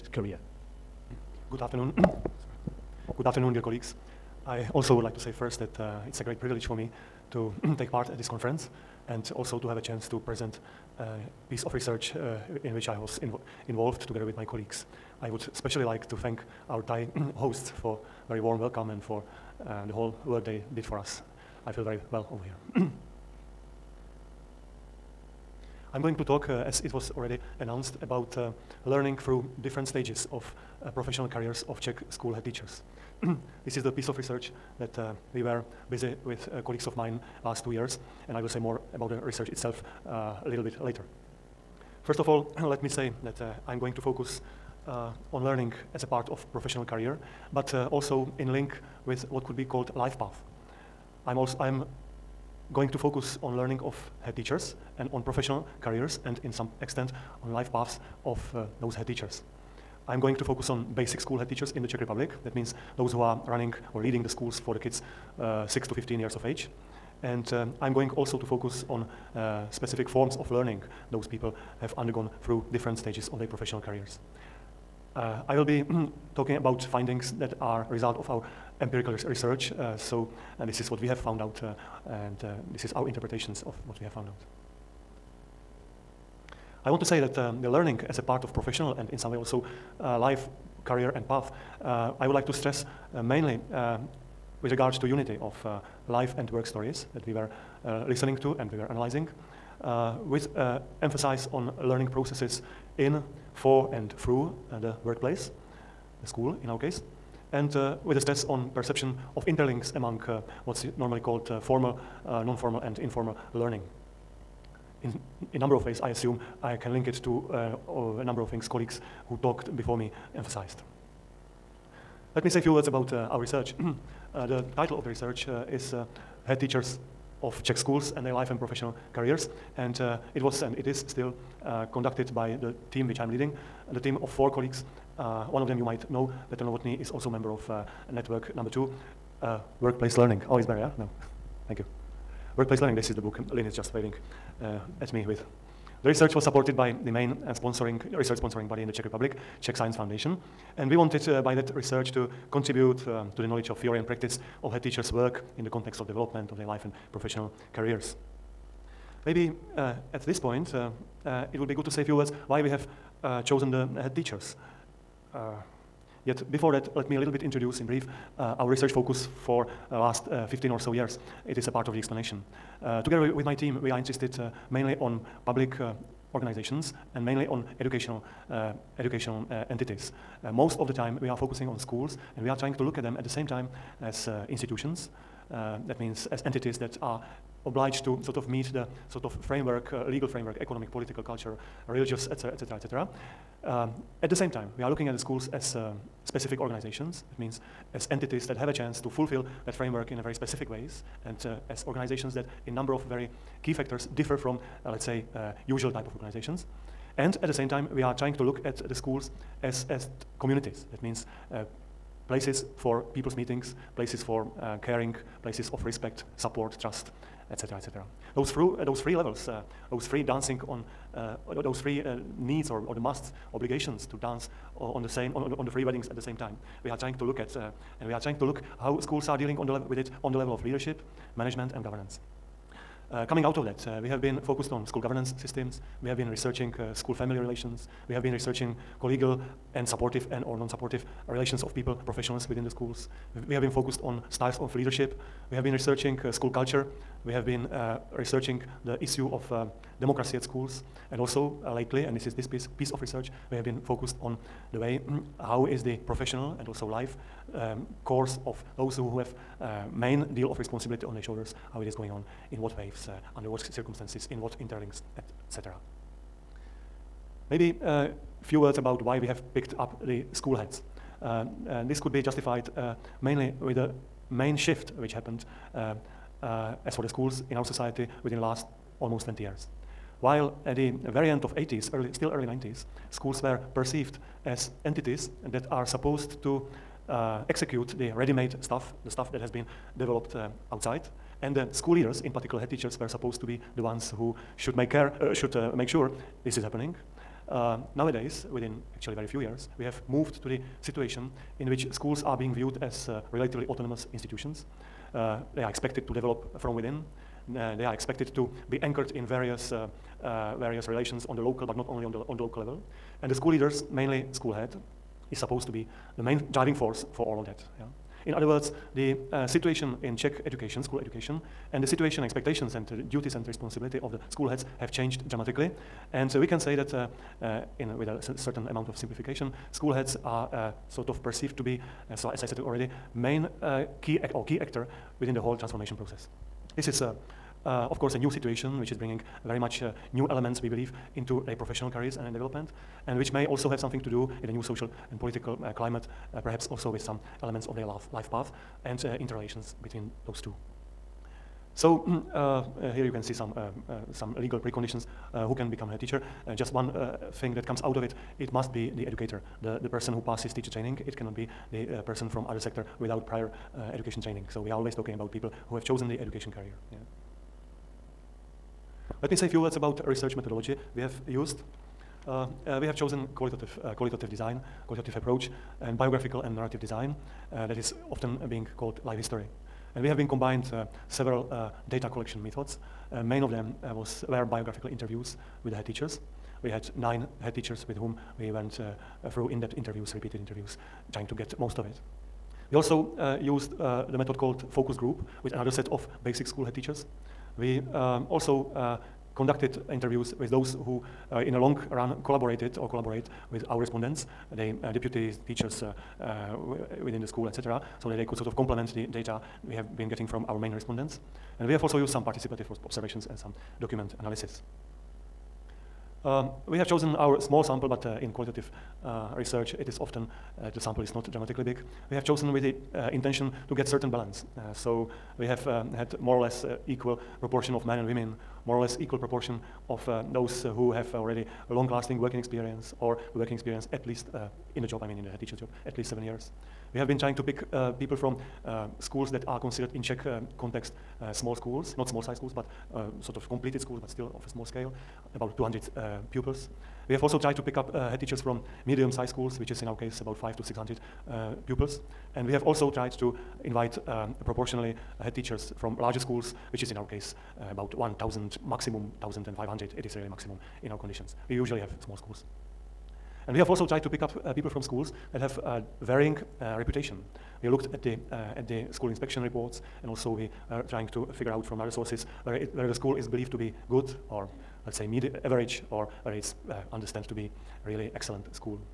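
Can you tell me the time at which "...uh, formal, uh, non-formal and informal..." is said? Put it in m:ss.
1:51.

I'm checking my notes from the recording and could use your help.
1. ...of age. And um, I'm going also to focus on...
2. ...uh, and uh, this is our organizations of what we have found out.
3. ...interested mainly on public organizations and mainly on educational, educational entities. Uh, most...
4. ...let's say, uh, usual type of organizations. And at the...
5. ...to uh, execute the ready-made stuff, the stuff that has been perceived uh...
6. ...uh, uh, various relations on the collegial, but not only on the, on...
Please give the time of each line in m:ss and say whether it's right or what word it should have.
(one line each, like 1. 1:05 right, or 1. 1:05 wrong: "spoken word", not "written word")
1. 1:06 right
2. 1:21 wrong: "interpretations", not "organizations"
3. 2:53 right
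4. 3:24 right
5. 4:46 wrong: "developed", not "perceived"
6. 5:09 wrong: "local", not "collegial".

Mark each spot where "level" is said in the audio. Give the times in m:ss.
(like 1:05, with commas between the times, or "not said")
3:39, 3:50, 5:12.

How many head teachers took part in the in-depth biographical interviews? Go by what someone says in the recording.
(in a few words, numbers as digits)
9.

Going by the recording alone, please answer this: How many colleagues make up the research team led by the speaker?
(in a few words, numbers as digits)
4.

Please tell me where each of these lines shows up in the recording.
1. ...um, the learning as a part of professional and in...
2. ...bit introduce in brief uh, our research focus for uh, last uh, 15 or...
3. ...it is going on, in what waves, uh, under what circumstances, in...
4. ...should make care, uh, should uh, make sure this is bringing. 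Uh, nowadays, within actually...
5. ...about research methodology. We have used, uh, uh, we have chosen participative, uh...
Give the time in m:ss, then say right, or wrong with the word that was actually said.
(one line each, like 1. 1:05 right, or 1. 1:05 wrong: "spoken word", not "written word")
1. 1:27 right
2. 2:47 right
3. 4:21 right
4. 4:54 wrong: "happening", not "bringing"
5. 6:09 wrong: "qualitative", not "participative".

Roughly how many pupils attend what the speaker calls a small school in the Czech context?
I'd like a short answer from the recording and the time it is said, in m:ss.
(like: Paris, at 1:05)
200, at 7:25.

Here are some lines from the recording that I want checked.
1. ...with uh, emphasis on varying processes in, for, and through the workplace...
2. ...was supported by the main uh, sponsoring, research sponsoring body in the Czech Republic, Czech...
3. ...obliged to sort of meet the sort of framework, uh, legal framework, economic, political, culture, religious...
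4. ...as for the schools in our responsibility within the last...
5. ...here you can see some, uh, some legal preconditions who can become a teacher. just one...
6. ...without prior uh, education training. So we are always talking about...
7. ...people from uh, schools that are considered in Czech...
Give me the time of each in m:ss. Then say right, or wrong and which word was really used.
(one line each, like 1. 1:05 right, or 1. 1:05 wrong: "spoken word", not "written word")
1. 1:40 wrong: "learning", not "varying"
2. 2:26 right
3. 3:07 right
4. 4:36 wrong: "society", not "responsibility"
5. 5:52 right
6. 6:02 right
7. 7:17 right.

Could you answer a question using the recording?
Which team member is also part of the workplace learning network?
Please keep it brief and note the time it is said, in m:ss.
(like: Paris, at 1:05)
Petr Novotny, at 2:16.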